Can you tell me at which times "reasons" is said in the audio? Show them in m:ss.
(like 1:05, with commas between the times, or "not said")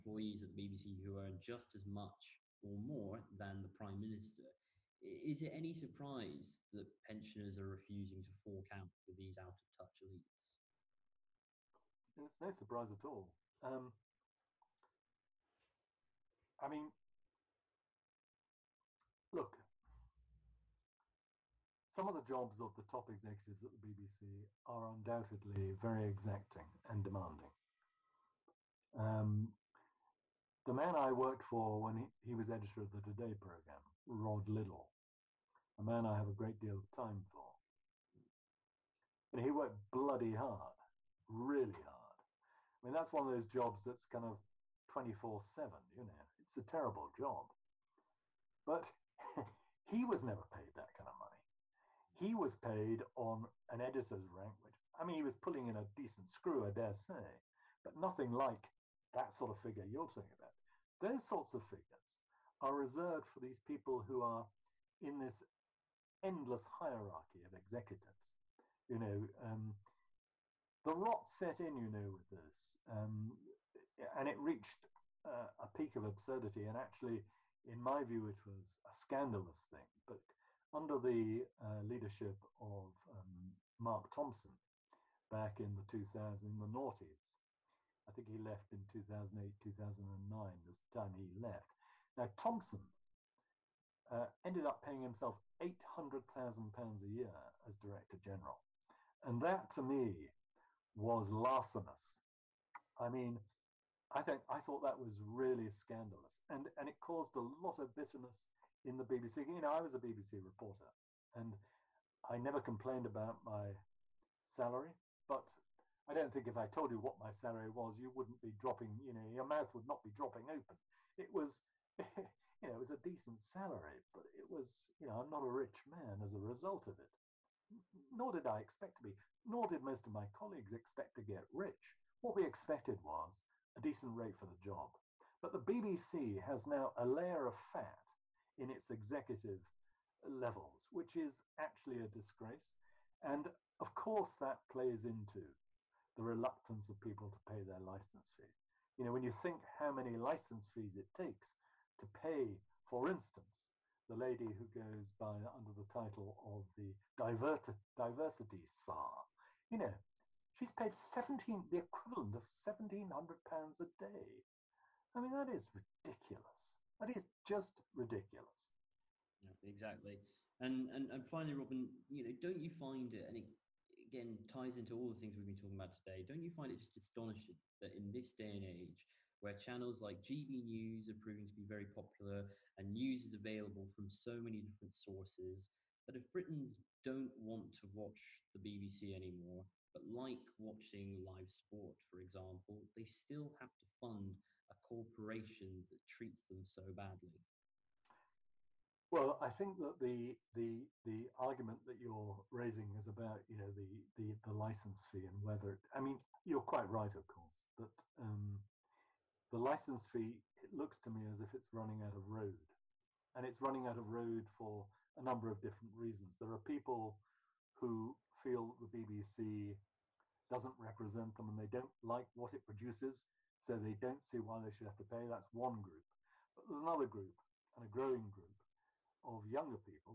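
3:35.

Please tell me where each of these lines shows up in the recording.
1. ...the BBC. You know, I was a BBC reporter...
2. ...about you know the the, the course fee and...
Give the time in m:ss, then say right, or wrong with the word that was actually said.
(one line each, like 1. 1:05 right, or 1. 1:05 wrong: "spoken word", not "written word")
1. 1:48 right
2. 3:23 wrong: "license", not "course".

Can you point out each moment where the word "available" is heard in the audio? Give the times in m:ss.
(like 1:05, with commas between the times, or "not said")
3:03.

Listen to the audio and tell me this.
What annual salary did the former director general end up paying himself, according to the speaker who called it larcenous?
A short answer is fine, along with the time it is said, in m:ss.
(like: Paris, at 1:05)
£800,000, at 1:35.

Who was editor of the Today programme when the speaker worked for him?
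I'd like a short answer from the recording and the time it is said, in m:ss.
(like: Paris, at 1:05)
Rod Liddle, at 0:34.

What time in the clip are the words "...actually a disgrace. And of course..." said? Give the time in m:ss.
2:21.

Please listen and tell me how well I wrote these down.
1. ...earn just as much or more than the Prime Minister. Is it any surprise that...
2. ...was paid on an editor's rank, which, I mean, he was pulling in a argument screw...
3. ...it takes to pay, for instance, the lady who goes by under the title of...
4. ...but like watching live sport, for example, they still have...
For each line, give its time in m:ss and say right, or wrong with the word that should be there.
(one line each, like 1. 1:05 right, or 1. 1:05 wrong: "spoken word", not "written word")
1. 0:01 right
2. 0:52 wrong: "decent", not "argument"
3. 2:30 right
4. 3:09 right.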